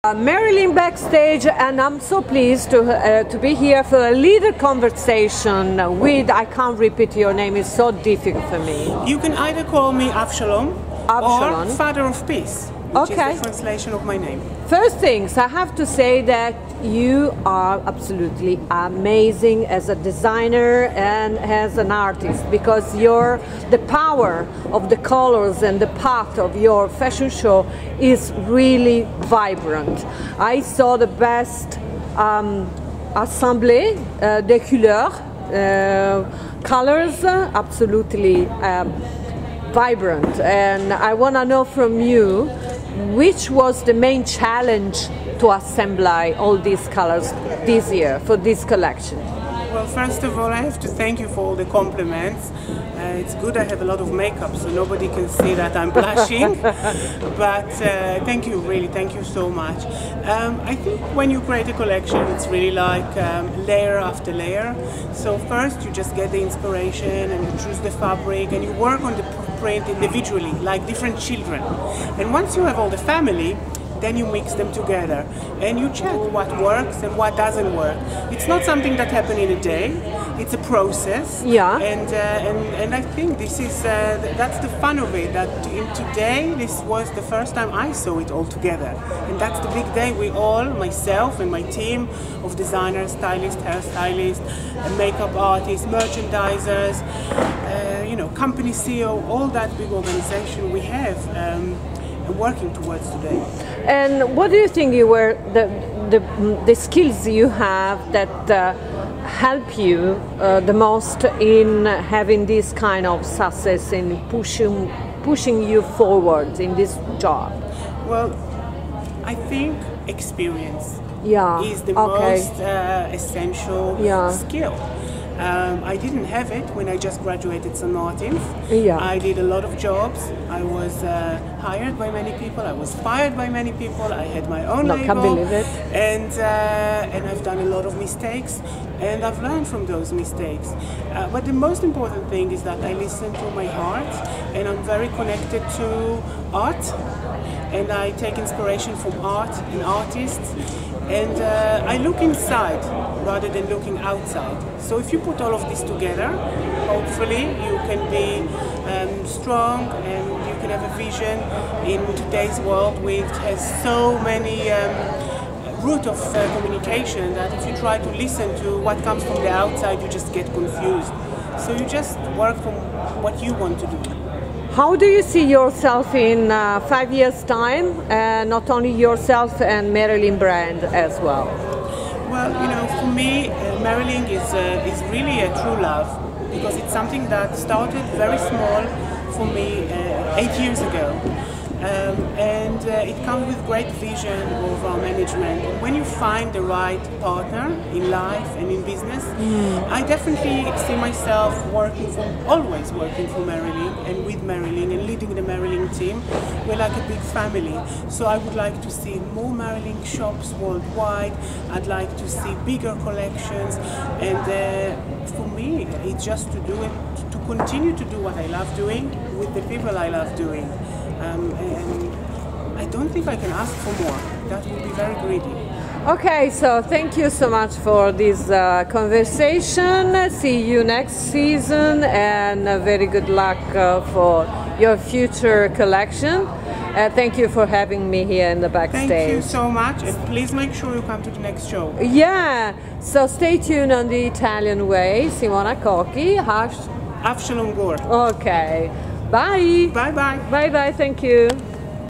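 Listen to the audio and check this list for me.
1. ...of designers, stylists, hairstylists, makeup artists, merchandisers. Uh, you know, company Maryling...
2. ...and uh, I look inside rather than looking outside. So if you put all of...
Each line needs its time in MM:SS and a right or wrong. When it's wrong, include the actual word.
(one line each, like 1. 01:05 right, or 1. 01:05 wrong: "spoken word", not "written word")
1. 01:32 wrong: "CEO", not "Maryling"
2. 02:31 right.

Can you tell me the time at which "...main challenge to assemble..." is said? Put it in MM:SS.
00:43.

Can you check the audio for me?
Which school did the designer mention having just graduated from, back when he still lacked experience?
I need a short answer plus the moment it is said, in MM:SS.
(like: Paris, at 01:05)
St. Martin's, at 02:07.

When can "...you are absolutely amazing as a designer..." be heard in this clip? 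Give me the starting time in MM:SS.
00:16.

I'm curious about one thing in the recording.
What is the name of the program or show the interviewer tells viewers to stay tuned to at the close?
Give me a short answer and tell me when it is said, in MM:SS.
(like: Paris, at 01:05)
The Italian Way, at 04:04.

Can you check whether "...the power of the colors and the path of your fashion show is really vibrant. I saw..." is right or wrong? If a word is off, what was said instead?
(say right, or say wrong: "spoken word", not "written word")
right.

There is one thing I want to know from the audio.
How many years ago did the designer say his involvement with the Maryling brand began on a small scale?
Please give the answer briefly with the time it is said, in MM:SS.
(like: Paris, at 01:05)
8, at 03:10.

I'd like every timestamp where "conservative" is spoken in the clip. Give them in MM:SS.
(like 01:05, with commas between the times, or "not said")
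not said.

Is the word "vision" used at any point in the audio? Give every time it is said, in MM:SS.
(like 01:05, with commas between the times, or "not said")
02:40, 03:13.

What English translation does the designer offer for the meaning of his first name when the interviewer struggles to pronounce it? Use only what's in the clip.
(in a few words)
Father of Peace.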